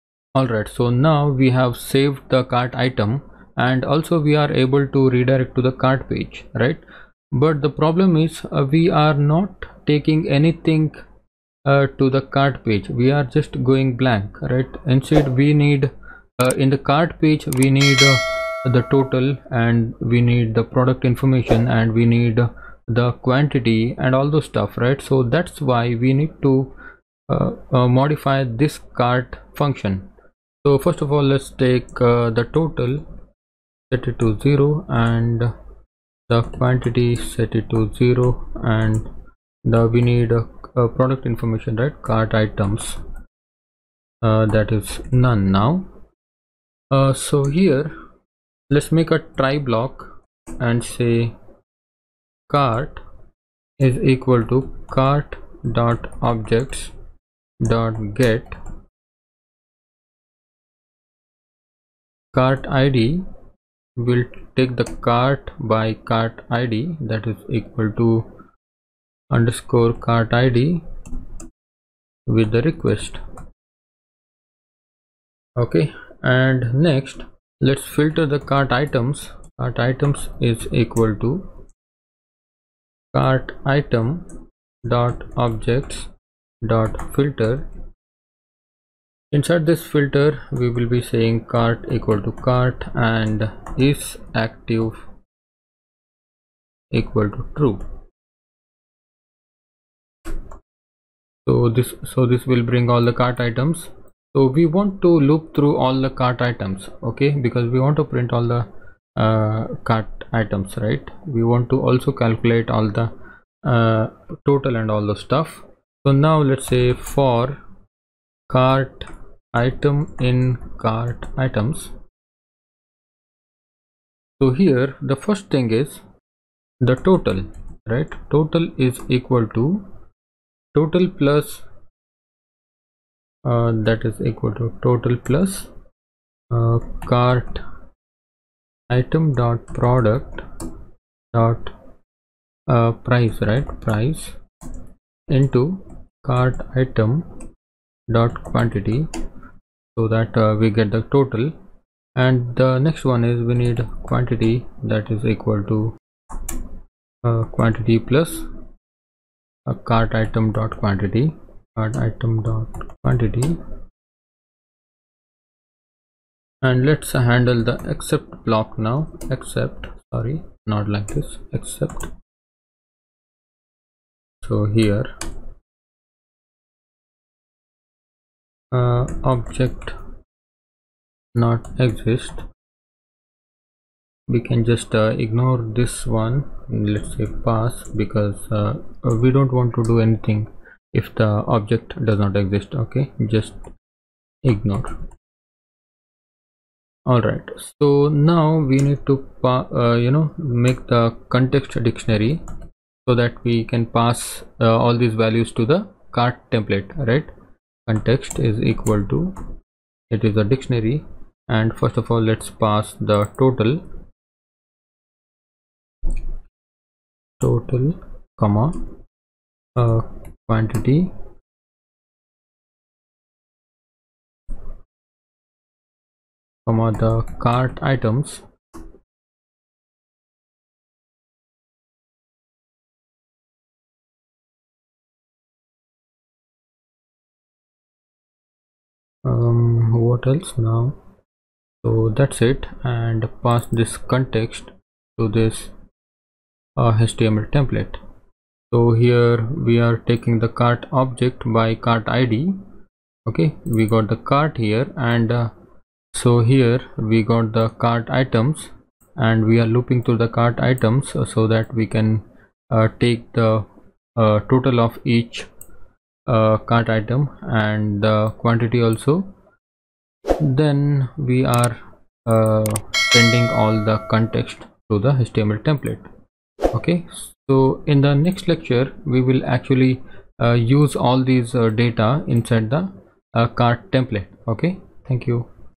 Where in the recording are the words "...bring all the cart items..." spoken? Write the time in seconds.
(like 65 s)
102 s.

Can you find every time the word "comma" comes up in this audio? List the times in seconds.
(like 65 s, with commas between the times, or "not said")
218 s, 226 s.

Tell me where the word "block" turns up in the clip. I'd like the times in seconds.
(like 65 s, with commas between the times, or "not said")
49 s, 168 s.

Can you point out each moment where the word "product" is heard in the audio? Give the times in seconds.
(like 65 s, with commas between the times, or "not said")
20 s, 40 s, 139 s.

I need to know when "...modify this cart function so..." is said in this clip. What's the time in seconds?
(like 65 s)
27 s.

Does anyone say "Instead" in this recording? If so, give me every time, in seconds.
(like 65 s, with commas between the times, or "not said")
14 s.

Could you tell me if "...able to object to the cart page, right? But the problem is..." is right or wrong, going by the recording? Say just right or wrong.
wrong.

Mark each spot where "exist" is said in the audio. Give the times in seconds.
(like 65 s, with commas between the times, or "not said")
181 s, 192 s.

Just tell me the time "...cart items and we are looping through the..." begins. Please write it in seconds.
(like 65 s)
257 s.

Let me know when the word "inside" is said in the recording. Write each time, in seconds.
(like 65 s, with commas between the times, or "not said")
89 s, 282 s.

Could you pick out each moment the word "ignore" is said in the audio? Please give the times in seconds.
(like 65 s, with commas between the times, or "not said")
185 s, 194 s.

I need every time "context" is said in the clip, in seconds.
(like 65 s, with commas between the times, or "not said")
201 s, 207 s, 243 s, 274 s.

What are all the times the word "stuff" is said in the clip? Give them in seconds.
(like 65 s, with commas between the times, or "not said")
24 s, 115 s.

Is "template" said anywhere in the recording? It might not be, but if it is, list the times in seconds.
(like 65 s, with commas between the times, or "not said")
206 s, 247 s, 275 s, 283 s.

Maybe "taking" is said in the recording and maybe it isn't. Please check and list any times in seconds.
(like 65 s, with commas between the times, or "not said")
9 s, 249 s.